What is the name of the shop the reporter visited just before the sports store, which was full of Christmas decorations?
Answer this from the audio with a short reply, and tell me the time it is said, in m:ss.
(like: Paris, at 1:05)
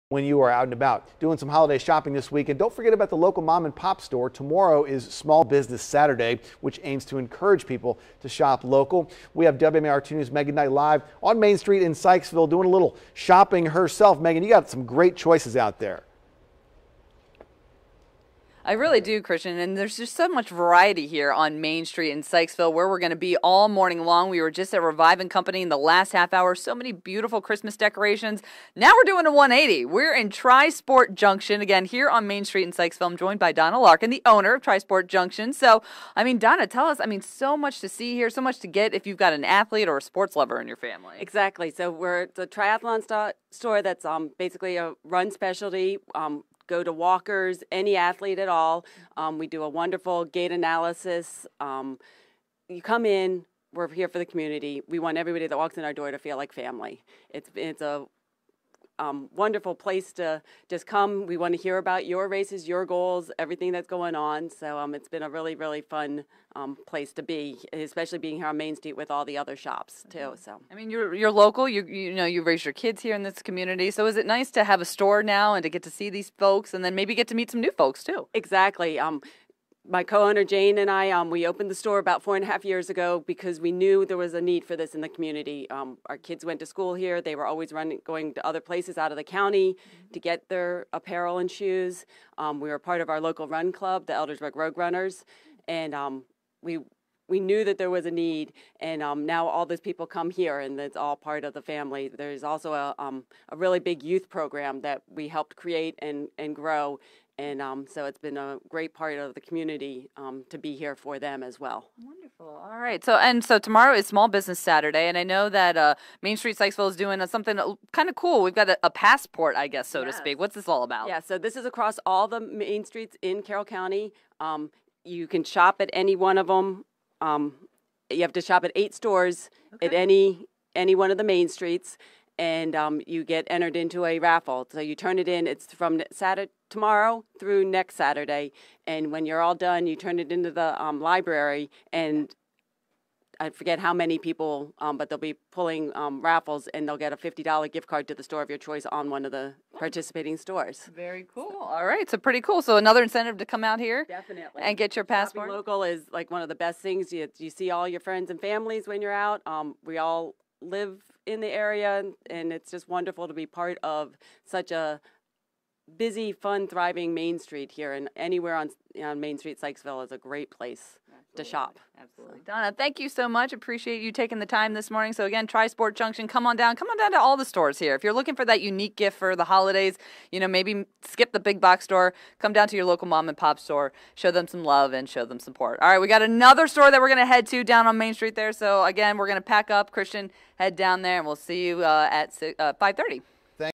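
Revive and Company, at 0:24.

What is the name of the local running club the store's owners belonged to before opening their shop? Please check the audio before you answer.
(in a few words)
Eldersburg Road Runners.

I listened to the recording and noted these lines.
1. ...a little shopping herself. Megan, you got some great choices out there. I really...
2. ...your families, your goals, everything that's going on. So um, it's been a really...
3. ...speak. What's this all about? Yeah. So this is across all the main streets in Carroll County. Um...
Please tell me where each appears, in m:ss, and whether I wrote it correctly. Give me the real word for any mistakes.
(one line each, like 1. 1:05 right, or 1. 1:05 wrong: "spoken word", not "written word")
1. 0:12 right
2. 1:02 wrong: "races", not "families"
3. 2:00 right.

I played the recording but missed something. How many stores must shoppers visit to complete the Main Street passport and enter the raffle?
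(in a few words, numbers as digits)
8.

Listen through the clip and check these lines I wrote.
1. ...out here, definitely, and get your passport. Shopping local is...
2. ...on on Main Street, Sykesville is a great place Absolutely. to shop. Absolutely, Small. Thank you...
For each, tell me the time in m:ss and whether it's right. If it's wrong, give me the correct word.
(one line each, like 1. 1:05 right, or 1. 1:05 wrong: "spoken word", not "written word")
1. 2:33 right
2. 2:48 wrong: "Donna", not "Small".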